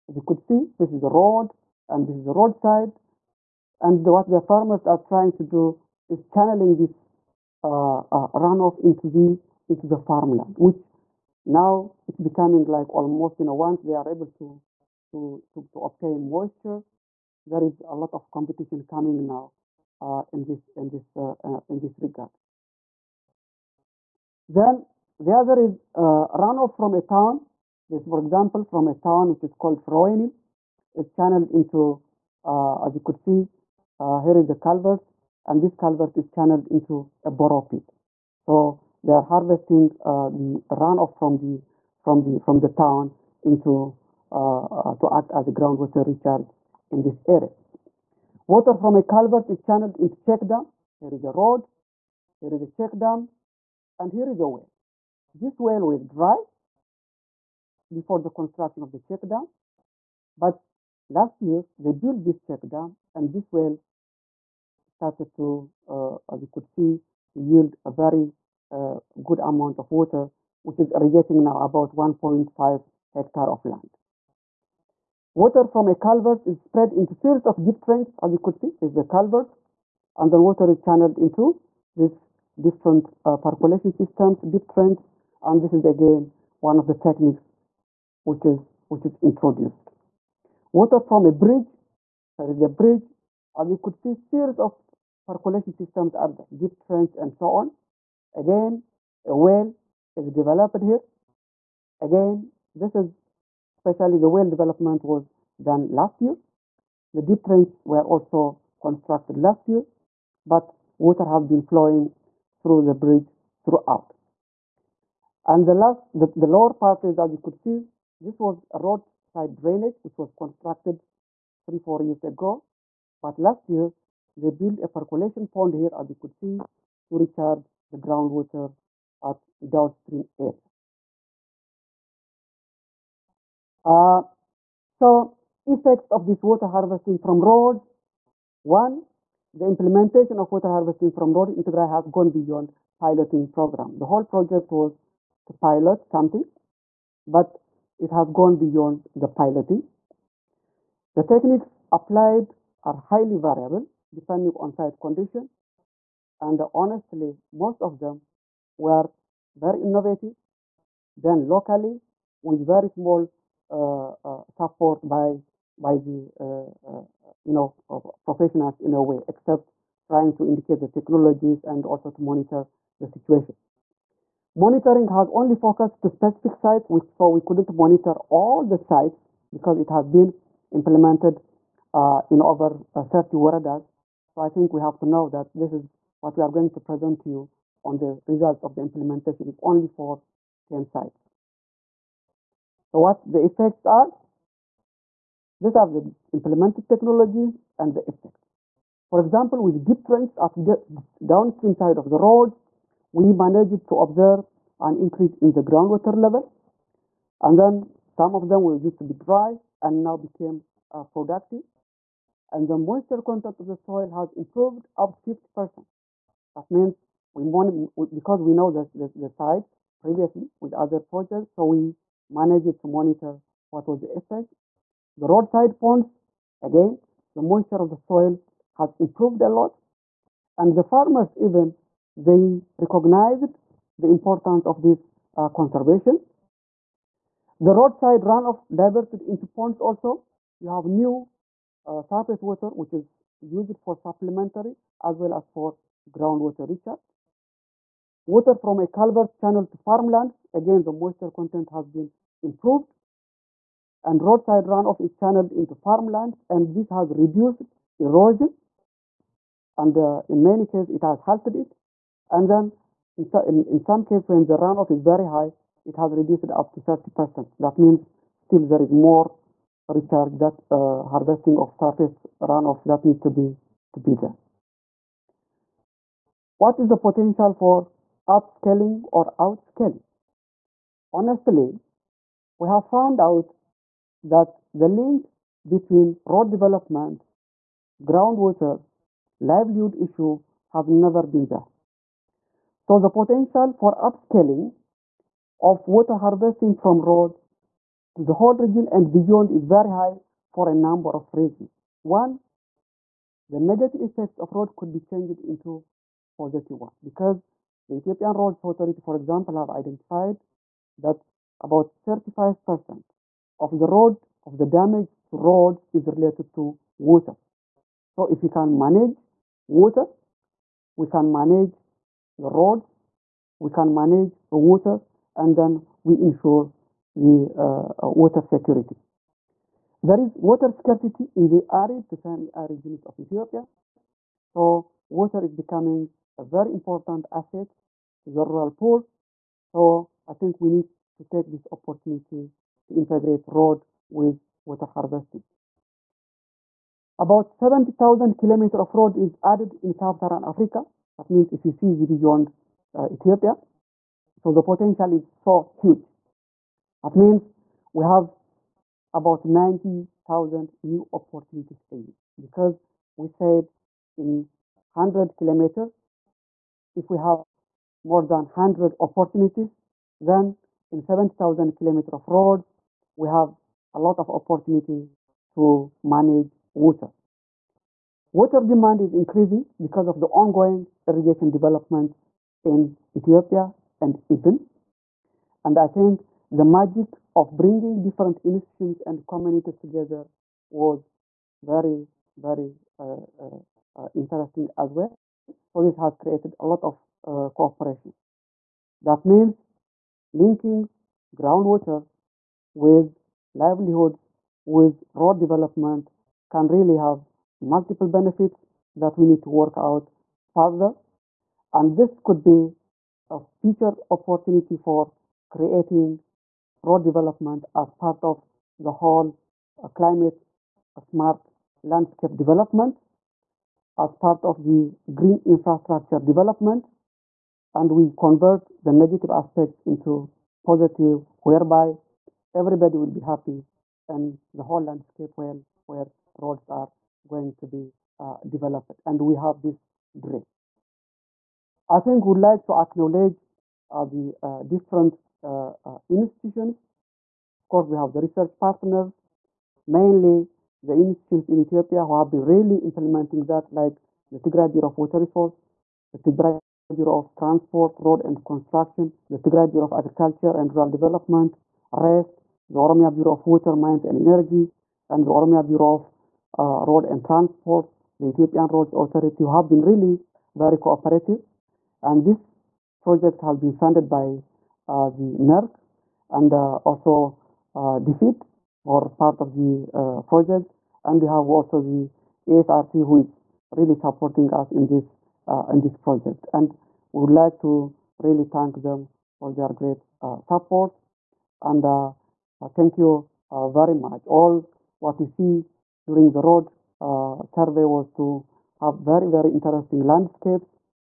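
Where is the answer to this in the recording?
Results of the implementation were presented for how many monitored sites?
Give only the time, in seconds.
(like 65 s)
190 s.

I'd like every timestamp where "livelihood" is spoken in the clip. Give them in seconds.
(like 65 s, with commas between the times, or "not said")
289 s, 403 s.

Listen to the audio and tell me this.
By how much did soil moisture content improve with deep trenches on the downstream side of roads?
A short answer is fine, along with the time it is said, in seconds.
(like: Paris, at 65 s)
up to 50%, at 215 s.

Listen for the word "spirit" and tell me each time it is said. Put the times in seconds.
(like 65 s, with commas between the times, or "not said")
not said.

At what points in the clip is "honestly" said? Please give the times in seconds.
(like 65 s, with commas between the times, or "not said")
156 s, 281 s.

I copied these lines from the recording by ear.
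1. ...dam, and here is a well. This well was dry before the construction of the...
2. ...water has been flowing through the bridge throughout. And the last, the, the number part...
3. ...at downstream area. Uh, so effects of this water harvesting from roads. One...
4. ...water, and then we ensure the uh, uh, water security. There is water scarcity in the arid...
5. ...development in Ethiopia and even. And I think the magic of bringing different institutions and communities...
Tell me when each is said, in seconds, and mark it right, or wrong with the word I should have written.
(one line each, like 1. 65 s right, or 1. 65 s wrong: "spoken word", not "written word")
1. 52 s right
2. 110 s wrong: "lower", not "number"
3. 129 s right
4. 324 s right
5. 381 s right.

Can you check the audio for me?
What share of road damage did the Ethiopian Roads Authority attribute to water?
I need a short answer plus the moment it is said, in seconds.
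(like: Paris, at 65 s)
35%, at 312 s.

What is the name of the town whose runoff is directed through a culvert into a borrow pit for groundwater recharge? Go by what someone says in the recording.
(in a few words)
Froeni.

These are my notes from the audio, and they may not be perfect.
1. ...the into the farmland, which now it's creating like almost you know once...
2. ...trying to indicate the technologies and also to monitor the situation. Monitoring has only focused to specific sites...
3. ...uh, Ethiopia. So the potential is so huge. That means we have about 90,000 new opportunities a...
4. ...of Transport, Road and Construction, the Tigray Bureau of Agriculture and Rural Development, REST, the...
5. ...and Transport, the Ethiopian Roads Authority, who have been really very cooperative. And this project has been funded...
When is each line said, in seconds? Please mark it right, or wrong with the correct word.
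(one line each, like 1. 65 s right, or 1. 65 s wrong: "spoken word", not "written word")
1. 9 s wrong: "becoming", not "creating"
2. 170 s right
3. 352 s right
4. 457 s right
5. 467 s right.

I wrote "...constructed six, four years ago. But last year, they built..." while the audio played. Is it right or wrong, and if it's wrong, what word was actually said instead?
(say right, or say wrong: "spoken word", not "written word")
wrong: "three", not "six".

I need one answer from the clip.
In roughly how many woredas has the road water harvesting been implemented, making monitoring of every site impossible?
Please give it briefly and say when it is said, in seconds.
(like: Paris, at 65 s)
over 30, at 182 s.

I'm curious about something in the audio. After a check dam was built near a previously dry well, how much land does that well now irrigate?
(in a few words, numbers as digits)
1.5 hectare.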